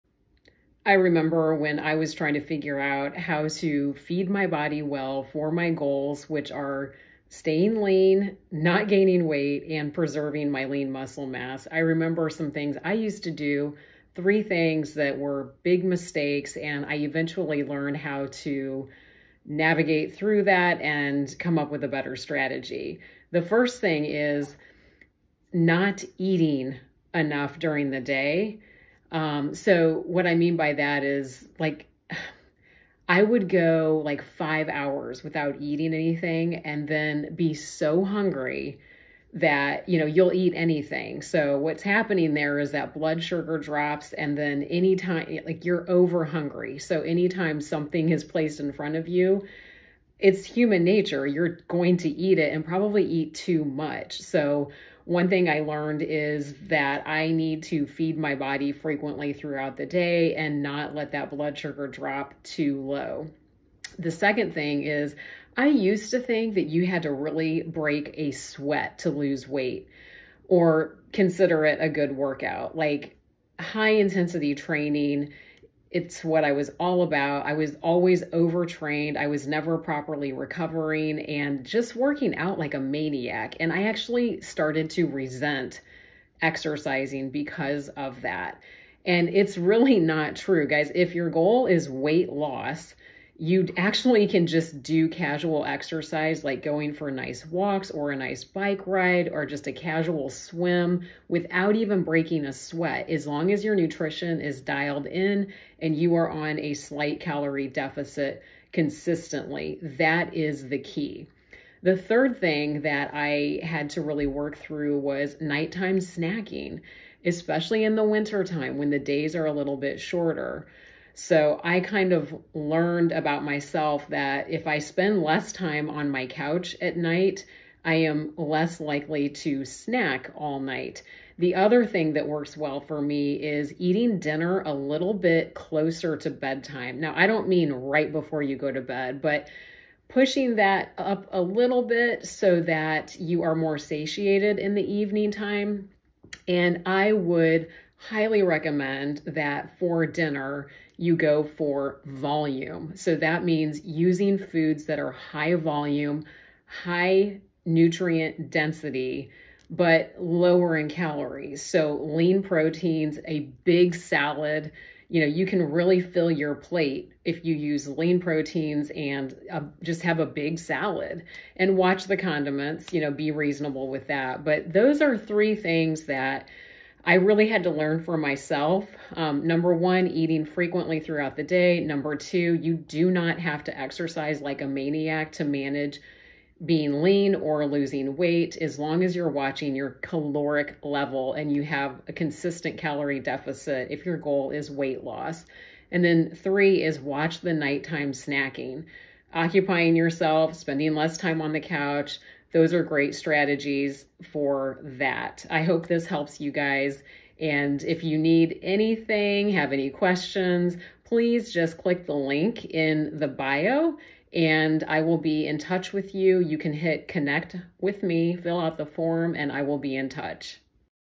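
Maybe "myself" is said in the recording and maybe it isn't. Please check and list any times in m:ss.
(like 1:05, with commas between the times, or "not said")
2:03, 2:58.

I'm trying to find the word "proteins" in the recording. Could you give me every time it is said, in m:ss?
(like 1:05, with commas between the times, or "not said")
2:42, 2:48.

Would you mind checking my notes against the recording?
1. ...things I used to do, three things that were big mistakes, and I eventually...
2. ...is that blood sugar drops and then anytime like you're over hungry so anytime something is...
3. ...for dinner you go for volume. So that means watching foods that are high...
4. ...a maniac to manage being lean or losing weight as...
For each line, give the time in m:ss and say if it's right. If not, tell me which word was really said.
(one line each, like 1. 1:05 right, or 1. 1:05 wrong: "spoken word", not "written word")
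1. 0:12 right
2. 0:42 right
3. 2:29 wrong: "using", not "watching"
4. 3:04 right.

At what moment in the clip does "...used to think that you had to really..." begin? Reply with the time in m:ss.
1:05.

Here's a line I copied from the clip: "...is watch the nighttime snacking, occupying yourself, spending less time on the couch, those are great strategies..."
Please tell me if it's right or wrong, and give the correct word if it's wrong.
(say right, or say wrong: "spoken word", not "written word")
right.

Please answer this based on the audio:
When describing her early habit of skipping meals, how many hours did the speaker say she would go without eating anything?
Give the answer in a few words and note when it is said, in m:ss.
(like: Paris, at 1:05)
5, at 0:34.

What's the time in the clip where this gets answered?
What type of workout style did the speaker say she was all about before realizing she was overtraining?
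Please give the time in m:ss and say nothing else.
1:13.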